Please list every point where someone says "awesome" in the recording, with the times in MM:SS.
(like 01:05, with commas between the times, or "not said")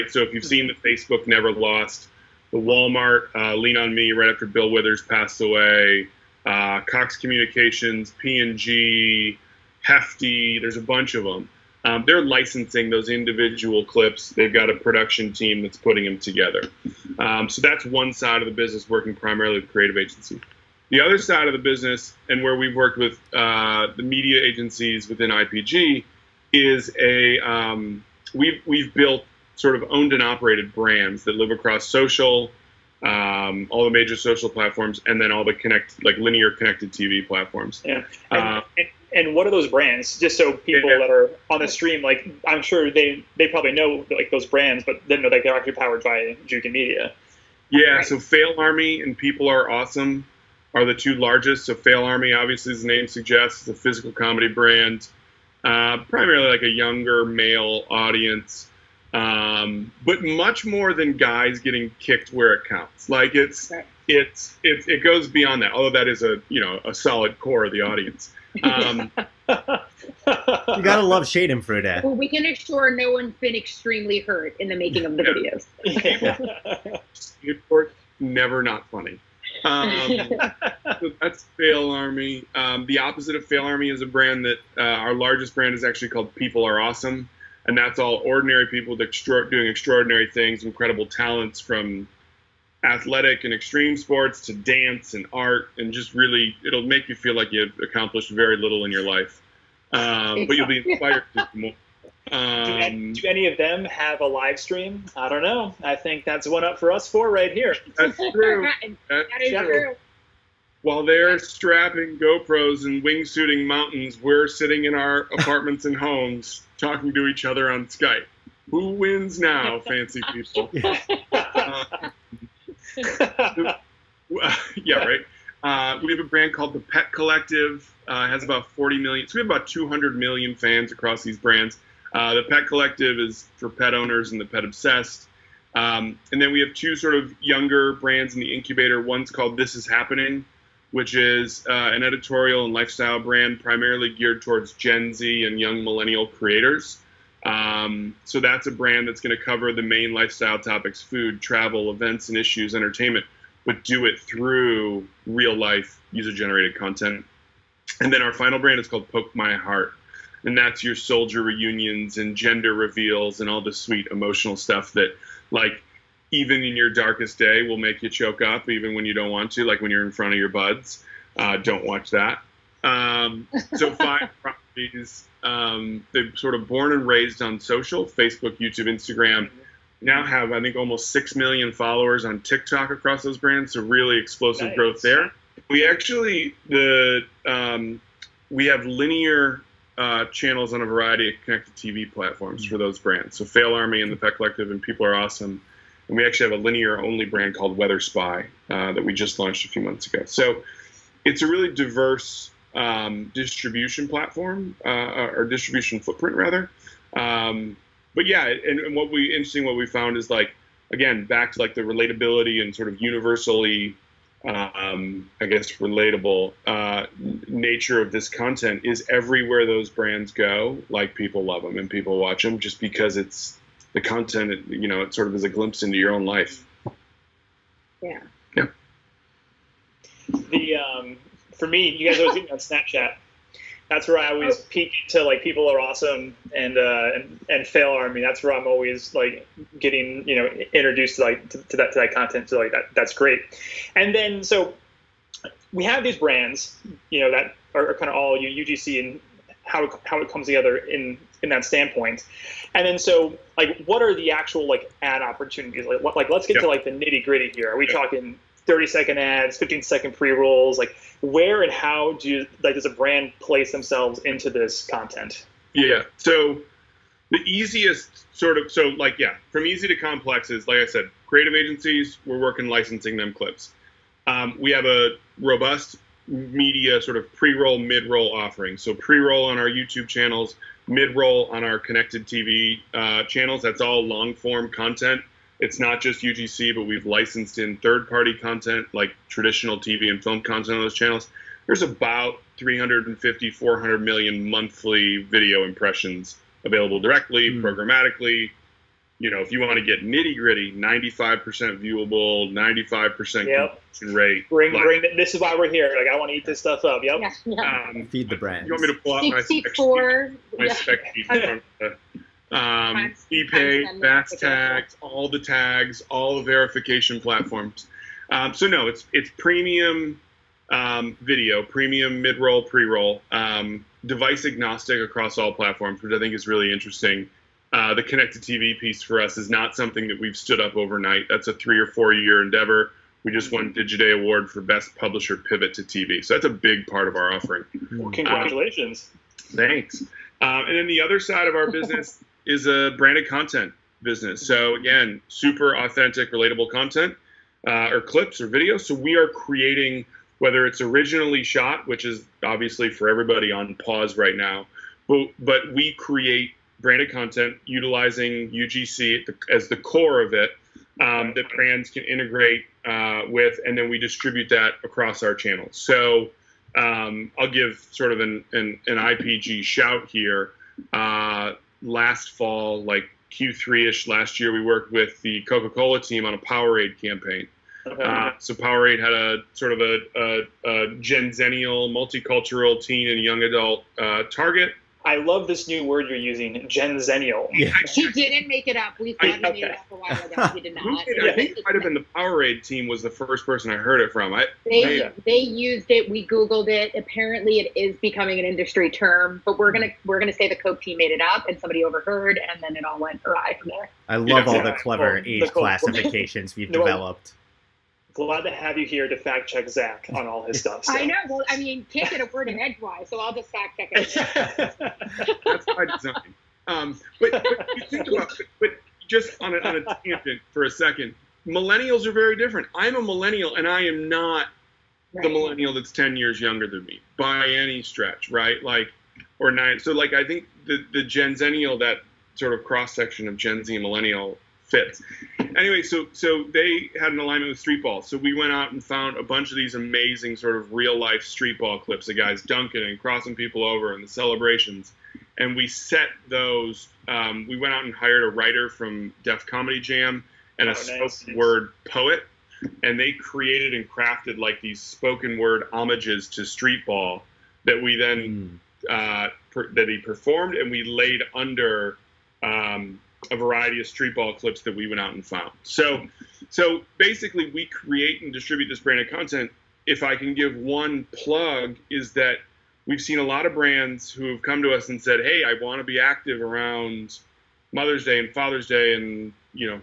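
00:49, 01:26, 03:15, 03:55.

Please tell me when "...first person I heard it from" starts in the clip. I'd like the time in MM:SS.
06:33.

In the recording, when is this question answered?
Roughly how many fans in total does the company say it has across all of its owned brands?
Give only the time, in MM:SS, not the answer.
02:09.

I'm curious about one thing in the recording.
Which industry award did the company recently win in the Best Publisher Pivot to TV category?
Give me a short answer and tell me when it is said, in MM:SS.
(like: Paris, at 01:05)
Digiday Award, at 05:33.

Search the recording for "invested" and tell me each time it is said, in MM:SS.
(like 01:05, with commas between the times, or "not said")
not said.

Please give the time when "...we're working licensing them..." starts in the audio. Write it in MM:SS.
04:32.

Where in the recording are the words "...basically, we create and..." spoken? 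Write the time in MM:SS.
07:46.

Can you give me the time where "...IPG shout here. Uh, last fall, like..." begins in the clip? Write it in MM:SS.
06:08.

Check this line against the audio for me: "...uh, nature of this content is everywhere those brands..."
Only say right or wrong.
right.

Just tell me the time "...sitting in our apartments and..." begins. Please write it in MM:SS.
01:54.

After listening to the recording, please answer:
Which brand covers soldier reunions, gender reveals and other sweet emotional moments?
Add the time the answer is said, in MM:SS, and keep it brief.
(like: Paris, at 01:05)
Poke My Heart, at 02:39.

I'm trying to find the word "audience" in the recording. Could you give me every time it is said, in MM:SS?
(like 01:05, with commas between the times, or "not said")
00:57, 01:07.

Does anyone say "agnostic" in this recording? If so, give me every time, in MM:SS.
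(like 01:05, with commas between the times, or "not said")
05:24.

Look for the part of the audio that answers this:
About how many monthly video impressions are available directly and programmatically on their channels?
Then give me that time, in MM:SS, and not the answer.
04:52.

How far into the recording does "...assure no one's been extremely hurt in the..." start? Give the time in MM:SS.
01:12.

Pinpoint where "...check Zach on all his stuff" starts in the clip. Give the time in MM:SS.
06:49.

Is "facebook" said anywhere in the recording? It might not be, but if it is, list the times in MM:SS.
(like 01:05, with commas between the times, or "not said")
00:00, 02:58.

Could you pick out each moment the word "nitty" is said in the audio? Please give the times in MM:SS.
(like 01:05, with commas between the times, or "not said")
04:16, 05:00.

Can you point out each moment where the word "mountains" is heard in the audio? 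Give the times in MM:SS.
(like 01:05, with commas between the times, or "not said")
01:53.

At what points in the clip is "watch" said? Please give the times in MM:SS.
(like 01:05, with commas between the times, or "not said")
02:51, 03:42.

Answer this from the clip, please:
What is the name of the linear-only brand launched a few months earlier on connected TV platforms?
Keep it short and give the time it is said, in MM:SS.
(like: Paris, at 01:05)
Weather Spy, at 03:17.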